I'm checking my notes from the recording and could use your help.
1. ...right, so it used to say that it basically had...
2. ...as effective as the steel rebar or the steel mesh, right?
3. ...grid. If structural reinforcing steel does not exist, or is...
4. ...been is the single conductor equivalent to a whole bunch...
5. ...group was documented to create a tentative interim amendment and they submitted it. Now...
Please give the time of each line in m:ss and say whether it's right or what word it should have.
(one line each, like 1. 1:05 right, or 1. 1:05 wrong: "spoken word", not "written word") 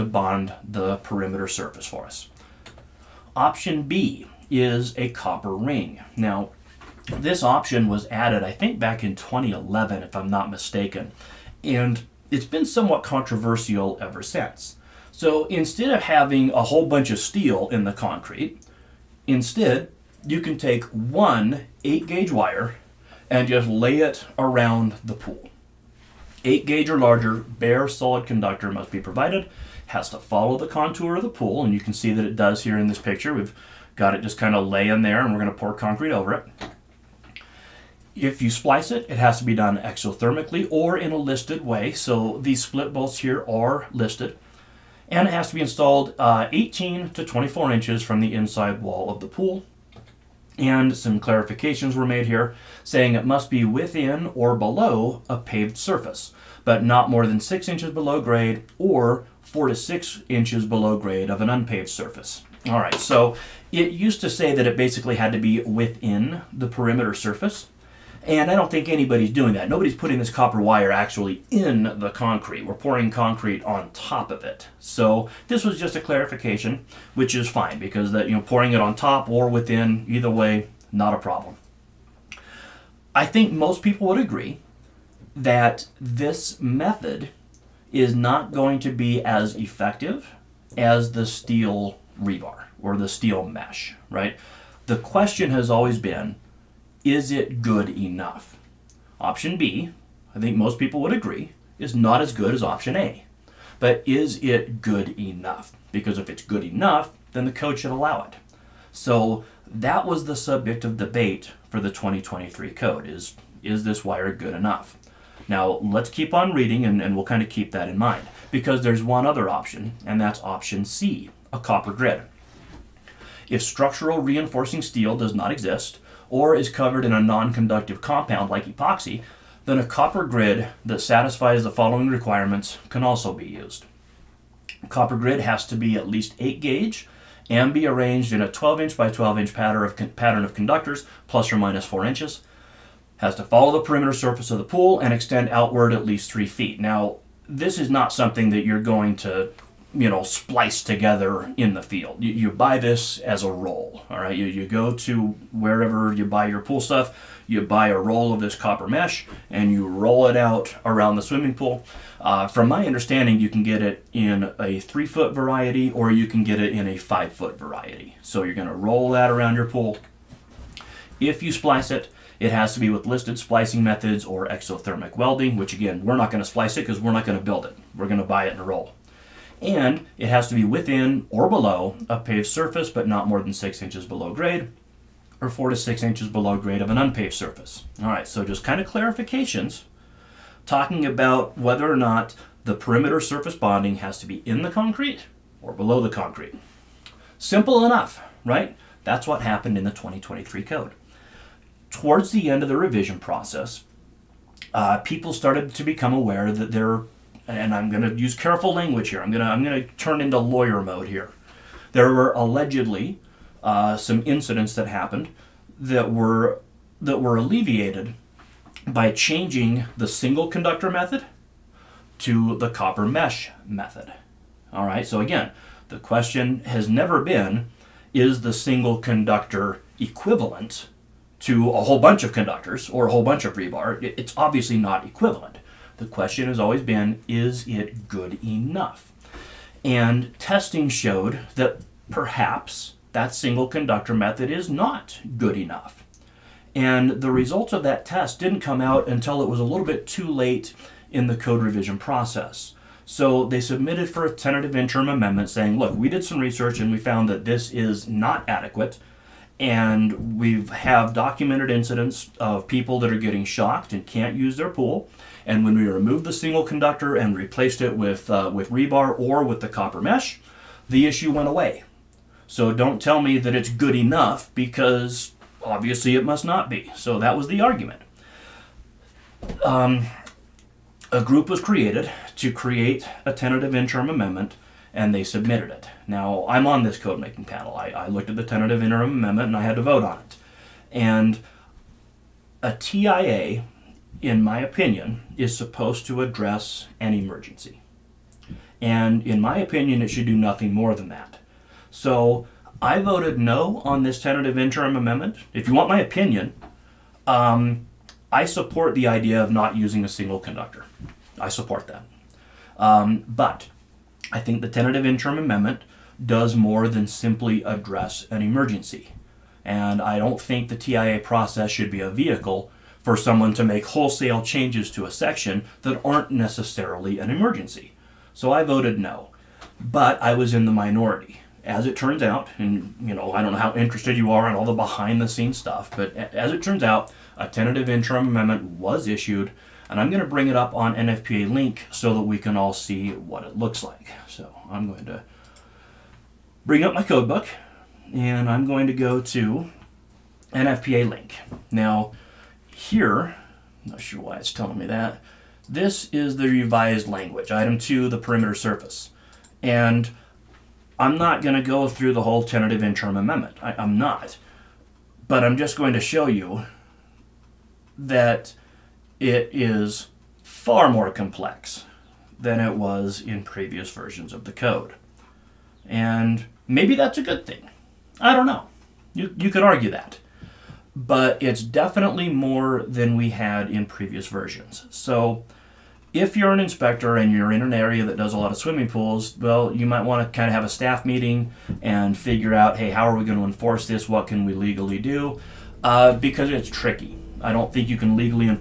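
1. 1:02 right
2. 1:29 right
3. 2:01 right
4. 3:47 right
5. 4:41 wrong: "created", not "documented".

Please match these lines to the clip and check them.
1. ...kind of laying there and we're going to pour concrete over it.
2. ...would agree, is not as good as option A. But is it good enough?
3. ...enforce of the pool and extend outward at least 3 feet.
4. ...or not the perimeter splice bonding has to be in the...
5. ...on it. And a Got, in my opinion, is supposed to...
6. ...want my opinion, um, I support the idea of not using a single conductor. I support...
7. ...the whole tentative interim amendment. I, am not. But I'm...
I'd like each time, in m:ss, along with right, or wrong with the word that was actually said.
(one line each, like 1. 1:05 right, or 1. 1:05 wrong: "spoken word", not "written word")
1. 0:34 right
2. 1:41 right
3. 2:24 wrong: "surface", not "enforce"
4. 3:11 wrong: "surface", not "splice"
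5. 4:50 wrong: "TIA", not "Got"
6. 5:05 right
7. 6:02 right.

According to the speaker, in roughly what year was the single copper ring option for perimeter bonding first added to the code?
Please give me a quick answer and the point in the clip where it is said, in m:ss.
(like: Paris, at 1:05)
2011, at 0:09.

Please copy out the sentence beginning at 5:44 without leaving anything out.
So I'm going to bring up my codebook and I'm going to go to NFPA link.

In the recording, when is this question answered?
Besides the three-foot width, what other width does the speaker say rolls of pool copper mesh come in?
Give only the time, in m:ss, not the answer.
2:46.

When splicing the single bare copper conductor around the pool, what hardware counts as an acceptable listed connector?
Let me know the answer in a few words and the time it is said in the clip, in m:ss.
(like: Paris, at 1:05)
split bolts, at 0:42.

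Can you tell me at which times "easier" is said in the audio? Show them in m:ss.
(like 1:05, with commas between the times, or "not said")
not said.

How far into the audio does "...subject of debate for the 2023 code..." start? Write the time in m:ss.
1:50.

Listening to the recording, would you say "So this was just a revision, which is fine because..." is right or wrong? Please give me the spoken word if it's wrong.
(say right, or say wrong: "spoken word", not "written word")
wrong: "clarification", not "revision".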